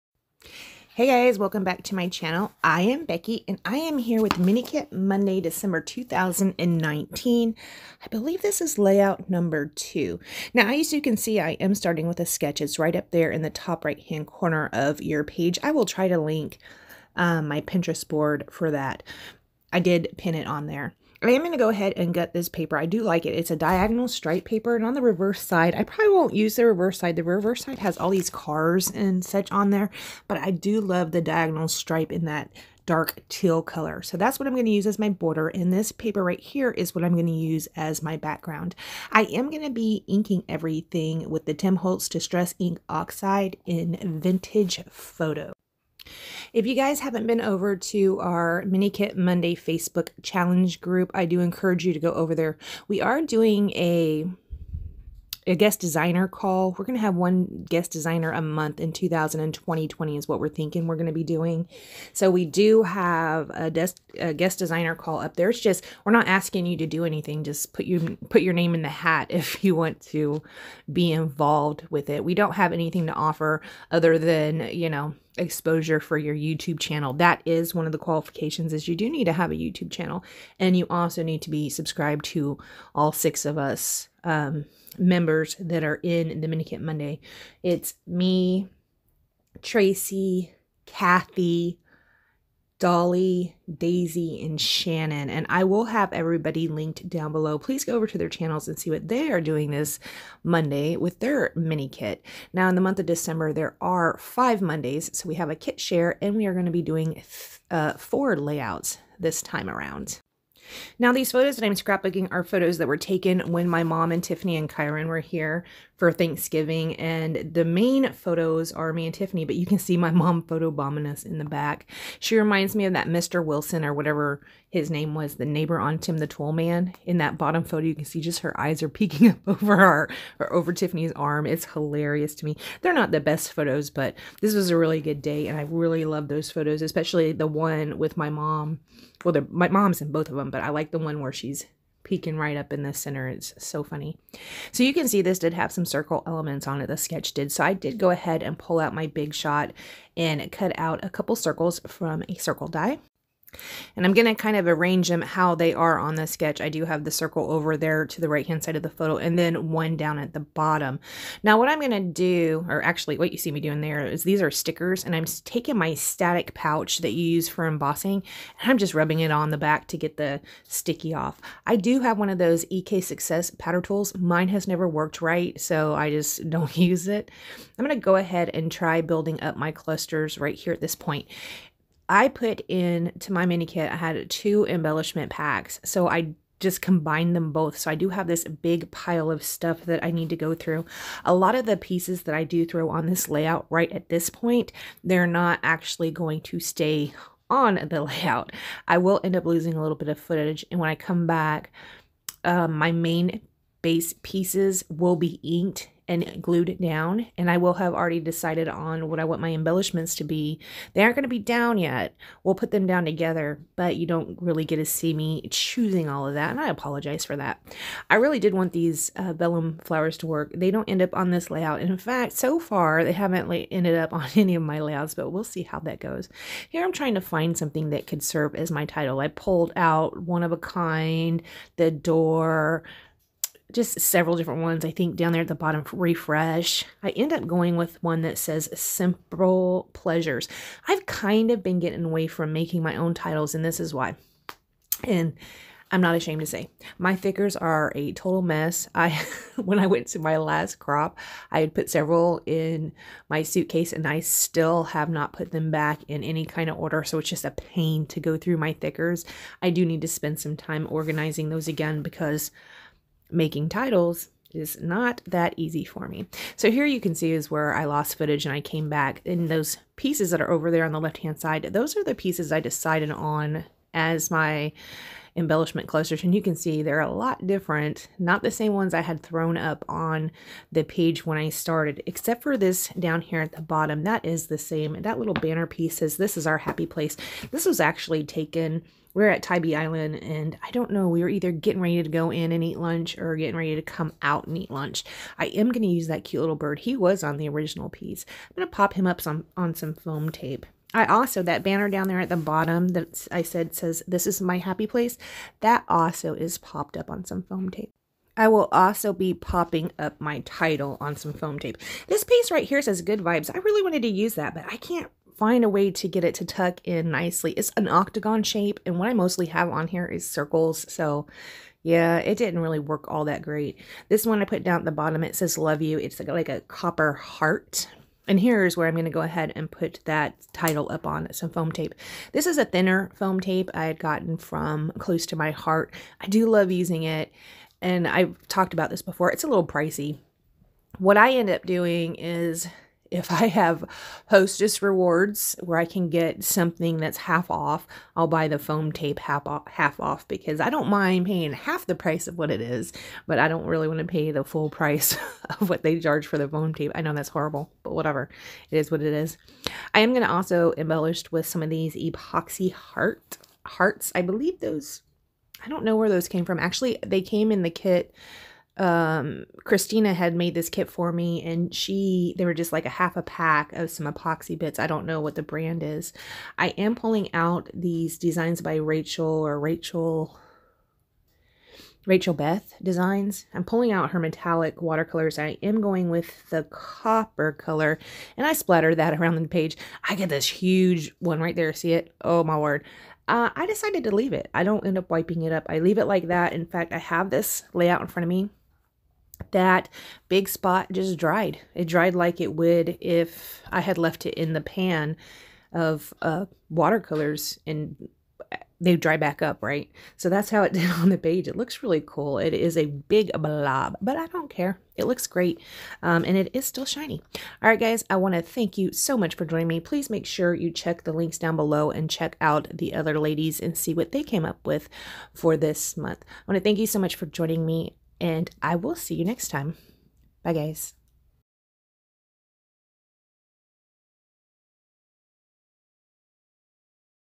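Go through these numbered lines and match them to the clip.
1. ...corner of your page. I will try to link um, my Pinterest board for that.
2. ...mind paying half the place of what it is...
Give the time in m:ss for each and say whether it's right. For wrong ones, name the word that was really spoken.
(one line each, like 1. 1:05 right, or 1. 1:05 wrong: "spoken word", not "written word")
1. 0:14 right
2. 5:50 wrong: "price", not "place".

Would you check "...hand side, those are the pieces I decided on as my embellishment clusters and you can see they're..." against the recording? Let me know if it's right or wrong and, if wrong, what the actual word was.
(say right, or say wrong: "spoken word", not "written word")
right.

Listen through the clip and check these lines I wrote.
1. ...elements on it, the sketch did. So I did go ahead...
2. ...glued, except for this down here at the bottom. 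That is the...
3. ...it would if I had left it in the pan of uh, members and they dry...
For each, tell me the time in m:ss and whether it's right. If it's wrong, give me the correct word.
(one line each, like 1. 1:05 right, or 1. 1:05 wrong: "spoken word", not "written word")
1. 2:26 right
2. 4:41 wrong: "started", not "glued"
3. 6:42 wrong: "watercolors", not "members".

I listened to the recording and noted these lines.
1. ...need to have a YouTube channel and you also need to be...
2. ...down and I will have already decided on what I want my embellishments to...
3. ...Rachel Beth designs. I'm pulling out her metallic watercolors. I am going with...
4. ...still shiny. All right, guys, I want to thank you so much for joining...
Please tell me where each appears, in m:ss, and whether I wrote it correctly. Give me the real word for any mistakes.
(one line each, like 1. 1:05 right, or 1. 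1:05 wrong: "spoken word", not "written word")
1. 1:19 right
2. 3:26 right
3. 6:22 right
4. 6:56 right.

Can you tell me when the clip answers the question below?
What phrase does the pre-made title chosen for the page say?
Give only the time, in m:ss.
3:58.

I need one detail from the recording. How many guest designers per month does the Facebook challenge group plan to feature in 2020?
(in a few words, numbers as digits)
1.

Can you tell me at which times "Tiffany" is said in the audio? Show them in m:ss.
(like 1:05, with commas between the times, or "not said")
1:54, 1:59, 2:10.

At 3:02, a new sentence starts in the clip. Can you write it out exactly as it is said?
I put in to my mini kit, I had two embellishment packs.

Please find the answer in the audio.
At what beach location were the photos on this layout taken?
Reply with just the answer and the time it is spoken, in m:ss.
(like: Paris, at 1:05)
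Tybee Island, at 4:49.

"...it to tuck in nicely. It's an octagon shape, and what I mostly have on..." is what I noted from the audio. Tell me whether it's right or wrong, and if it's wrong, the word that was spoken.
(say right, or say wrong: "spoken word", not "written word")
right.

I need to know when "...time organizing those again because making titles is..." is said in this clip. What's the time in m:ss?
4:20.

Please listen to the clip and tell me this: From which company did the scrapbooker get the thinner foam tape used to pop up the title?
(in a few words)
Close to My Heart.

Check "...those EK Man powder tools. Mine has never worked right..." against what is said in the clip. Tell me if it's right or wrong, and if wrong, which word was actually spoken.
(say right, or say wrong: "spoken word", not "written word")
wrong: "Success", not "Man".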